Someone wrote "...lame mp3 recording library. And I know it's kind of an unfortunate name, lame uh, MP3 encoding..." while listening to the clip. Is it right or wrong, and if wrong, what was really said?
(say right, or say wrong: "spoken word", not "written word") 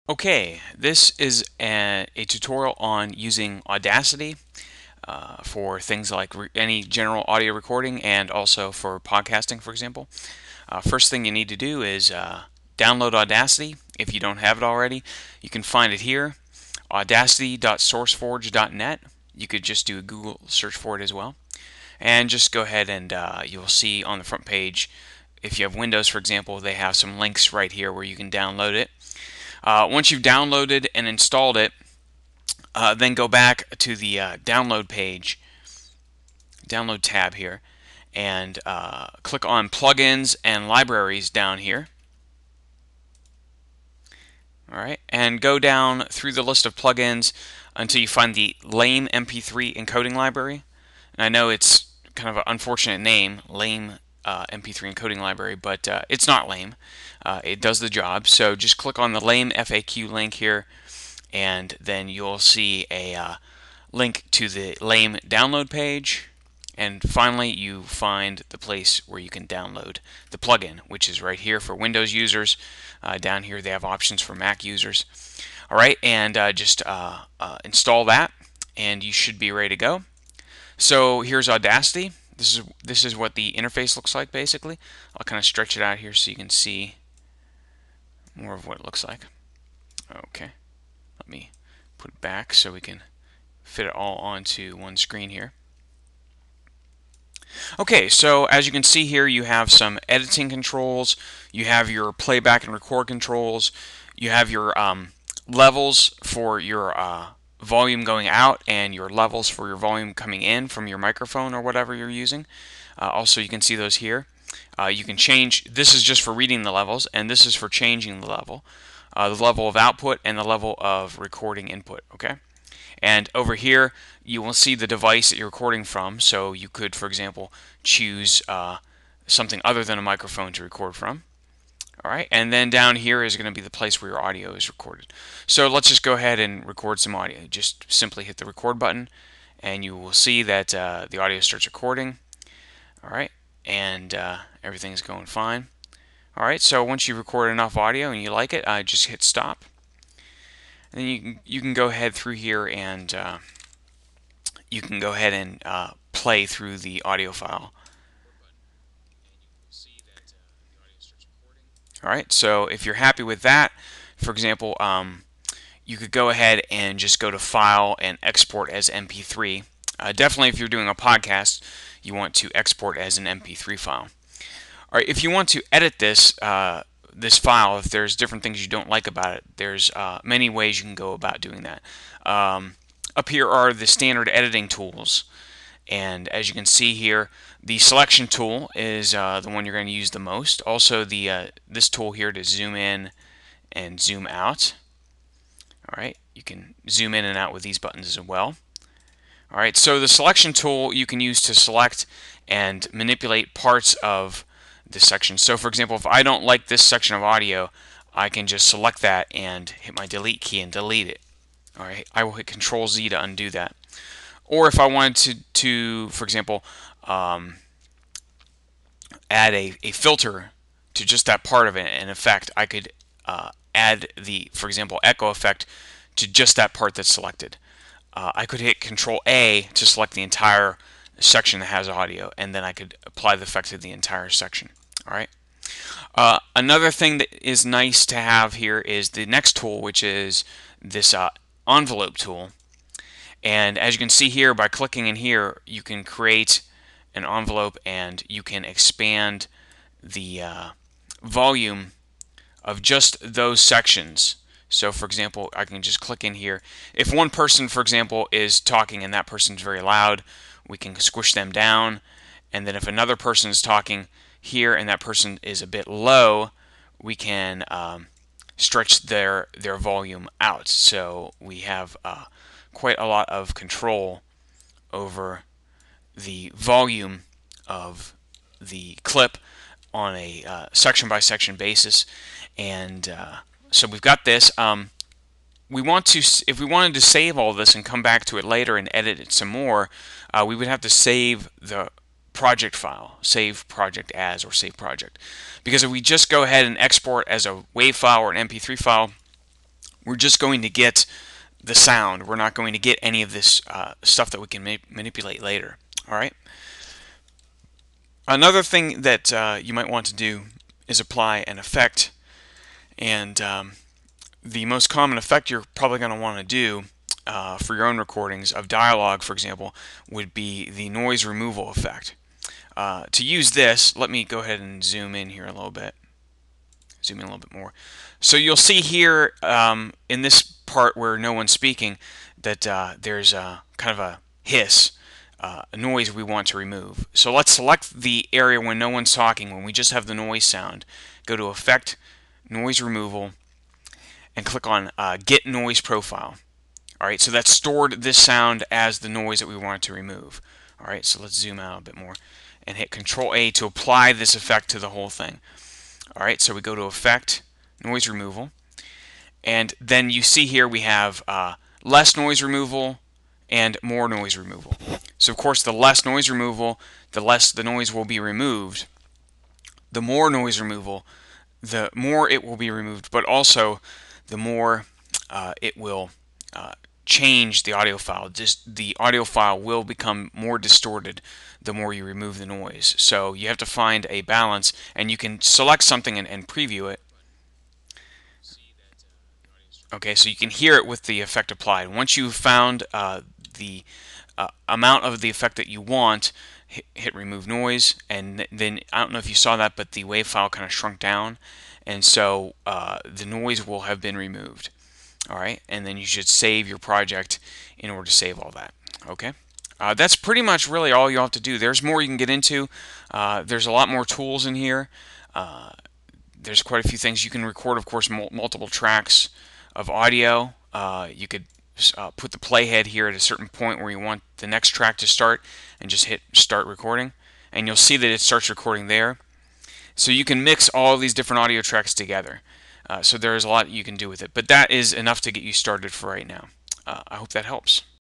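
wrong: "encoding", not "recording".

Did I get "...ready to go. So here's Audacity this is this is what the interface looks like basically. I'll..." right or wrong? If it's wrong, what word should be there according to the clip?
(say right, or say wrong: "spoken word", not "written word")
right.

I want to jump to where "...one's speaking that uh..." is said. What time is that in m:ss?
5:31.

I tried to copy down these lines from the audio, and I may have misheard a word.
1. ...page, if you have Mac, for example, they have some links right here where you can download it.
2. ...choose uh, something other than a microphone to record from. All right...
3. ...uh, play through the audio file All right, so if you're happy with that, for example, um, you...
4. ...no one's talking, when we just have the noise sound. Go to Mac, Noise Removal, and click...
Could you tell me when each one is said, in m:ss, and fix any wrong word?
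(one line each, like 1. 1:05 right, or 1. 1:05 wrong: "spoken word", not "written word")
1. 0:24 wrong: "Windows", not "Mac"
2. 2:07 right
3. 2:35 right
4. 5:38 wrong: "Effect", not "Mac".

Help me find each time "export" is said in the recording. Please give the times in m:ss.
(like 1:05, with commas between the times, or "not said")
2:48, 2:52, 4:56.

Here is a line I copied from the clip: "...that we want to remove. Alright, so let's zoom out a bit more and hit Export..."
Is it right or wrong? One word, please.
wrong.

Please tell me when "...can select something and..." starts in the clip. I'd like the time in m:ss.
6:25.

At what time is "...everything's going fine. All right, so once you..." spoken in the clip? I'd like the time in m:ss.
2:24.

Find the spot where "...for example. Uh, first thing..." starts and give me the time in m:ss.
0:09.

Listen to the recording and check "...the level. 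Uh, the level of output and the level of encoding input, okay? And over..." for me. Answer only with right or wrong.
wrong.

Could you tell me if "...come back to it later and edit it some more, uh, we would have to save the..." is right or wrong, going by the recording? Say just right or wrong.
right.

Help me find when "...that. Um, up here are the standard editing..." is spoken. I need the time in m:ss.
3:01.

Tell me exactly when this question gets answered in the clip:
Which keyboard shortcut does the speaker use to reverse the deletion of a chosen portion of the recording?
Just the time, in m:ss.
3:32.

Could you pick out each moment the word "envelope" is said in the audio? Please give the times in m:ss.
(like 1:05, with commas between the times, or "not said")
4:01, 4:07.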